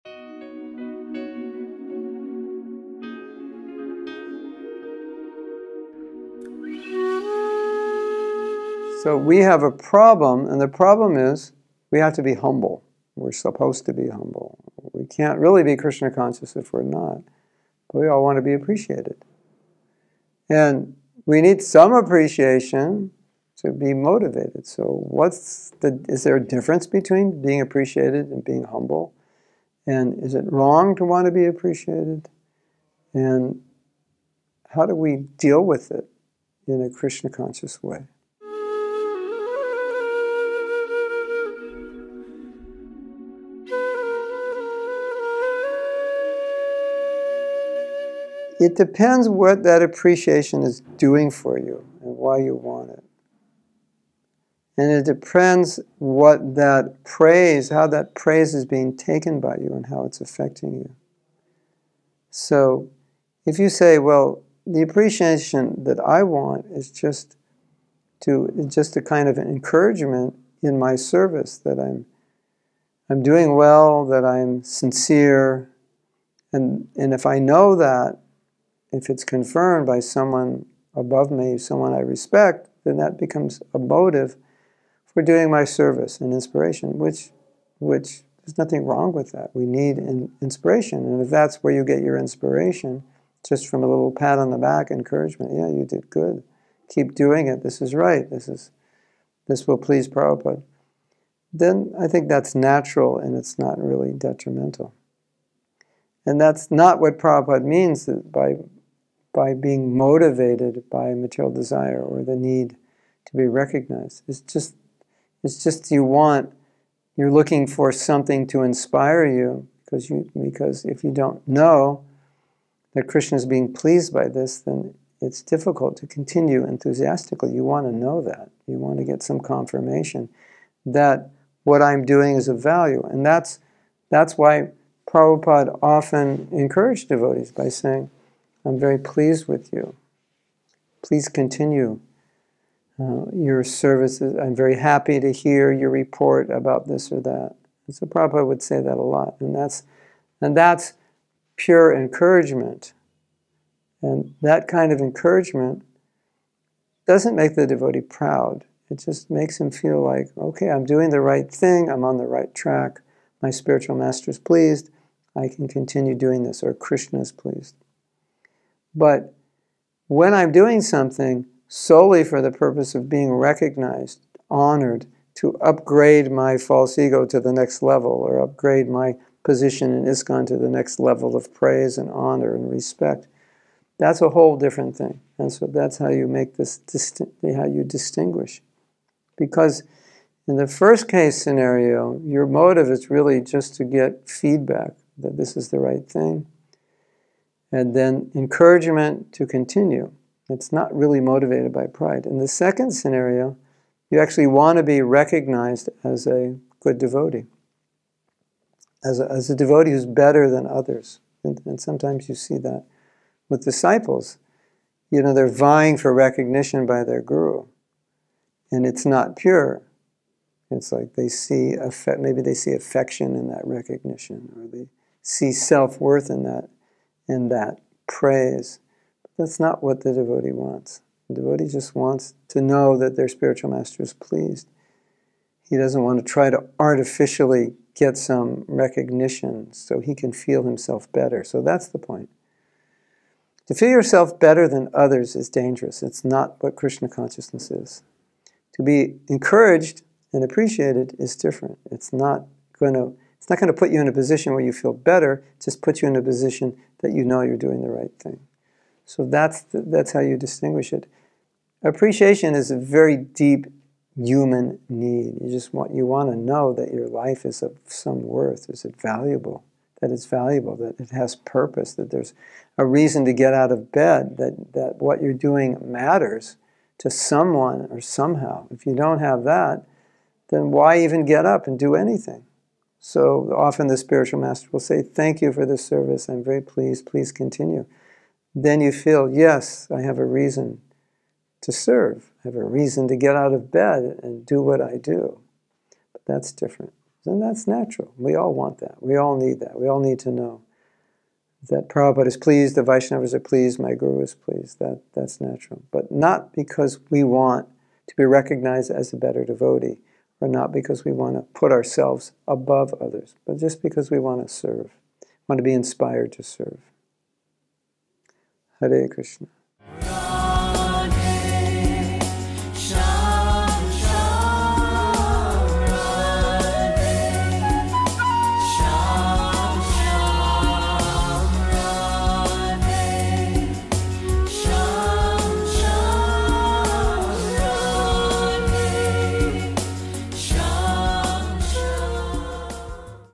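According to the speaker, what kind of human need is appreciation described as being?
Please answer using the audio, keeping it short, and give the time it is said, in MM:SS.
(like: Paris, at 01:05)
a very deep human need, at 04:22.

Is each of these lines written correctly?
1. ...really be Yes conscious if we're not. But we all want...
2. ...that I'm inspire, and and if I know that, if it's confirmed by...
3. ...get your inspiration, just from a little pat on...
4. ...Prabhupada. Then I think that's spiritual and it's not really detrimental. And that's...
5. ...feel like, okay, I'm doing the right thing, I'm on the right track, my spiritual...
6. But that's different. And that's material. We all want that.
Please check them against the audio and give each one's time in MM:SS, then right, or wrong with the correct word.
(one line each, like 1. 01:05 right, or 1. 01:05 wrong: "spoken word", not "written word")
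1. 00:15 wrong: "Krishna", not "Yes"
2. 01:14 wrong: "sincere", not "inspire"
3. 01:31 right
4. 01:40 wrong: "natural", not "spiritual"
5. 02:39 right
6. 04:56 wrong: "natural", not "material".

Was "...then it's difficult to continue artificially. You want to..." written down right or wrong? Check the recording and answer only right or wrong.
wrong.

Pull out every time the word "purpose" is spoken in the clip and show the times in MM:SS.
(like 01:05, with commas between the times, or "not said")
02:52, 04:31.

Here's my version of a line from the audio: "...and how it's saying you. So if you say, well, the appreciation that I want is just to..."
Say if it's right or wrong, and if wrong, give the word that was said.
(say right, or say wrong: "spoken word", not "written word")
wrong: "affecting", not "saying".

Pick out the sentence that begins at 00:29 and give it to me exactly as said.
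And is it wrong to want to be appreciated?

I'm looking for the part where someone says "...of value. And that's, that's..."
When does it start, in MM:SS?
02:12.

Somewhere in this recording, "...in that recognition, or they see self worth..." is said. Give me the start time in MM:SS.
03:43.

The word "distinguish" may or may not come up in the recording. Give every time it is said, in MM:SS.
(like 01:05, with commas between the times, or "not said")
03:07, 04:20.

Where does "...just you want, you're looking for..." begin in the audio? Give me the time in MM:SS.
01:55.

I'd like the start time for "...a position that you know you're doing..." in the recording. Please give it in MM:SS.
04:16.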